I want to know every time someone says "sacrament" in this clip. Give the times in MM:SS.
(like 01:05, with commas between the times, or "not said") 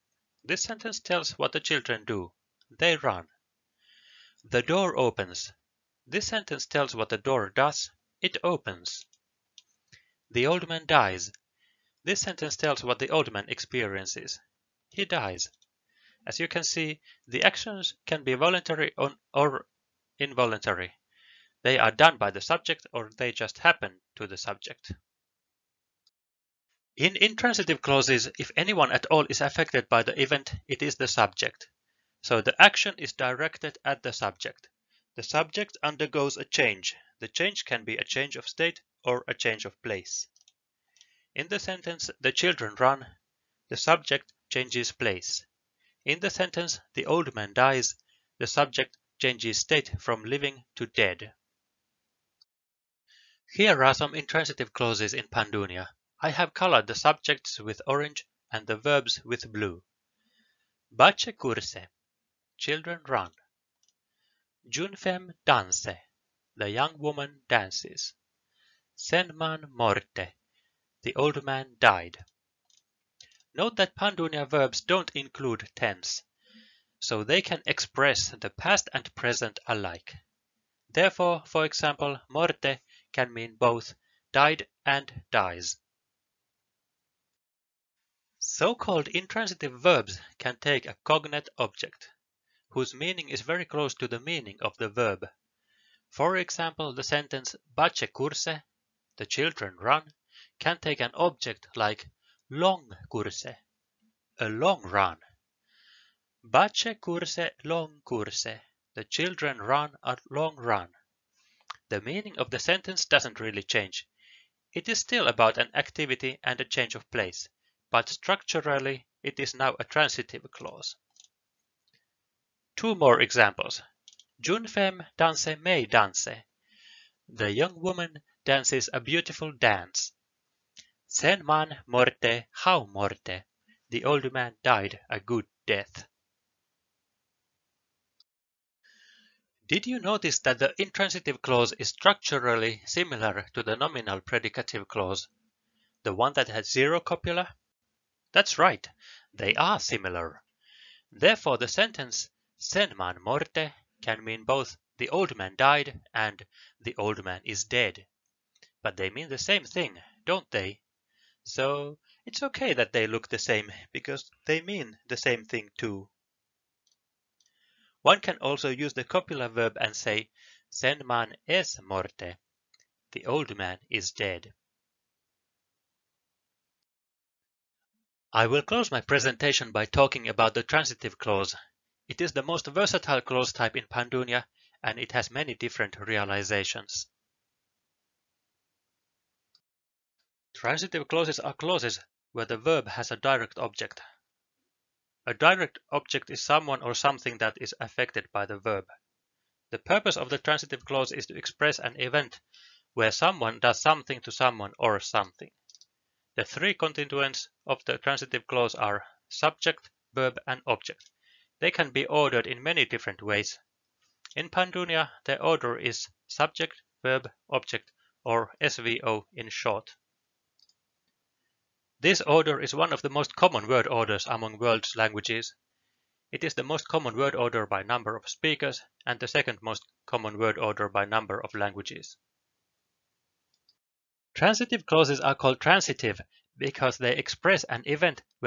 not said.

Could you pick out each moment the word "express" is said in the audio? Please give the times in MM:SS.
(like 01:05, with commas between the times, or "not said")
01:17, 03:21, 03:57.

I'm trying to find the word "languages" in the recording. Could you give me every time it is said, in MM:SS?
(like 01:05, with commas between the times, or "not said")
03:44, 03:51.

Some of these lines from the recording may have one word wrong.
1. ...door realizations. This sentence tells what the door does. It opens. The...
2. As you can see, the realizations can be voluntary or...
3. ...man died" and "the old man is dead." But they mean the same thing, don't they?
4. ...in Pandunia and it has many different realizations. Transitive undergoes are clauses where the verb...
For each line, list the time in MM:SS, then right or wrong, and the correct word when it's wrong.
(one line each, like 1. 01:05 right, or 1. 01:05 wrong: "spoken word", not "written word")
1. 00:04 wrong: "opens", not "realizations"
2. 00:16 wrong: "actions", not "realizations"
3. 02:35 right
4. 03:03 wrong: "clauses", not "undergoes".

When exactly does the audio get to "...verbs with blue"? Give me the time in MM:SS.
00:58.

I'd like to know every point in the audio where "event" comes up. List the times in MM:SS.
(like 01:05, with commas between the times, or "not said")
00:30, 03:21, 03:57.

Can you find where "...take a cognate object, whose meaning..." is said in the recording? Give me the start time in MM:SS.
01:30.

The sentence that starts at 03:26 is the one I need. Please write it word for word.
The three constituents of the transitive clause are subject, verb and object.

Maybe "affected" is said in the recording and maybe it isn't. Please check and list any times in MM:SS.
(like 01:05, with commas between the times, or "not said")
00:29, 03:17.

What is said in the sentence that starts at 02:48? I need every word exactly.
One can also use the copula verb and say "sen man es morte." The old man is dead.